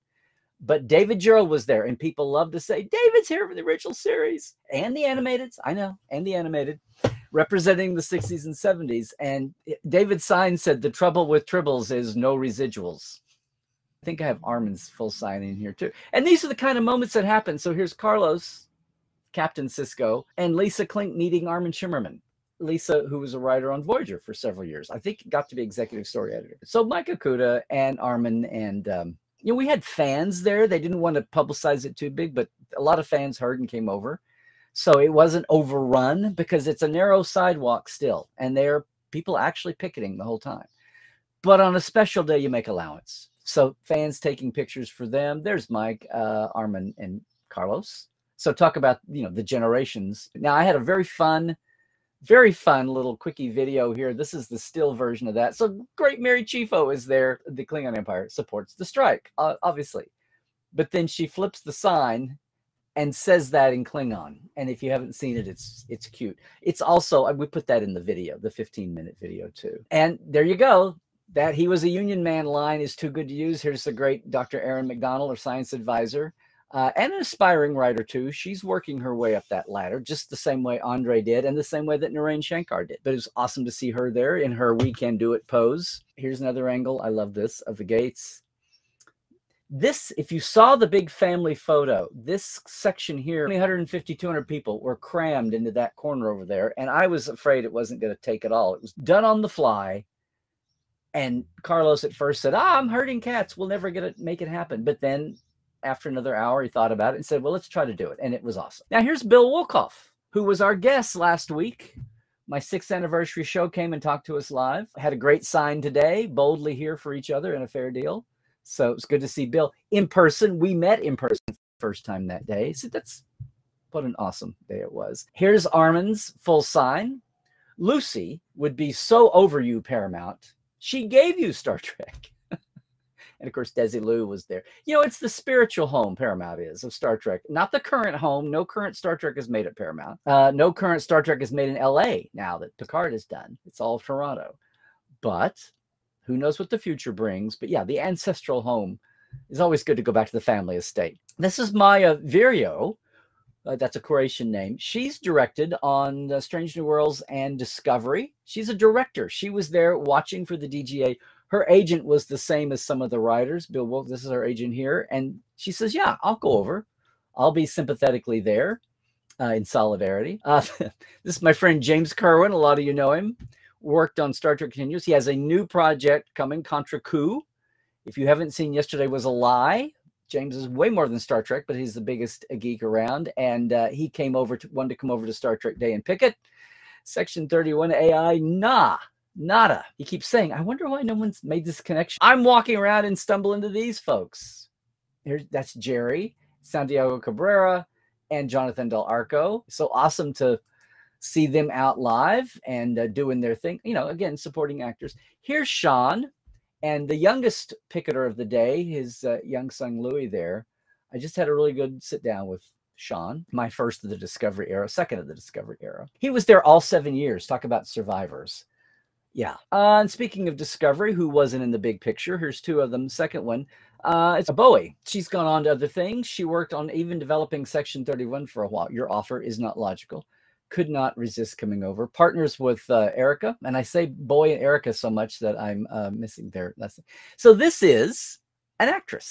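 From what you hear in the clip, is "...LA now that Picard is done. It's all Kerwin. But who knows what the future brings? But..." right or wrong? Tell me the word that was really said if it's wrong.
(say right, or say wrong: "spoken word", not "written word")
wrong: "Toronto", not "Kerwin".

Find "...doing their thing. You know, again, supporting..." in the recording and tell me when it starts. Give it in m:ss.
3:23.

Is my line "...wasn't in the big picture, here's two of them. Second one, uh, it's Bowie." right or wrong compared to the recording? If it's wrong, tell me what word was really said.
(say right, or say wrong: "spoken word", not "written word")
right.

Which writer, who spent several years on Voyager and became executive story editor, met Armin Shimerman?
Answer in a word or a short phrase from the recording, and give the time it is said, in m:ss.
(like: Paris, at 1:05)
Lisa Klink, at 0:20.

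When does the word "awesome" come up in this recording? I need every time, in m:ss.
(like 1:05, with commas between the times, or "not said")
1:23, 1:48, 2:04, 3:19.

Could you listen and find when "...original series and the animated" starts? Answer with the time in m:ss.
0:03.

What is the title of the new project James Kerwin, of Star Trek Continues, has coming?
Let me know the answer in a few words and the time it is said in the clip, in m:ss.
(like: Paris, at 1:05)
Contra Coup, at 2:56.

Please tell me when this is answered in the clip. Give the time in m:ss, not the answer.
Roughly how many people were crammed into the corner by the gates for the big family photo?
1:33.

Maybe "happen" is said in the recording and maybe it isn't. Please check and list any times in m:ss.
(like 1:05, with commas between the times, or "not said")
0:17, 1:44.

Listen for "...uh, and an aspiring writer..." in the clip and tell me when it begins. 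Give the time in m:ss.
1:16.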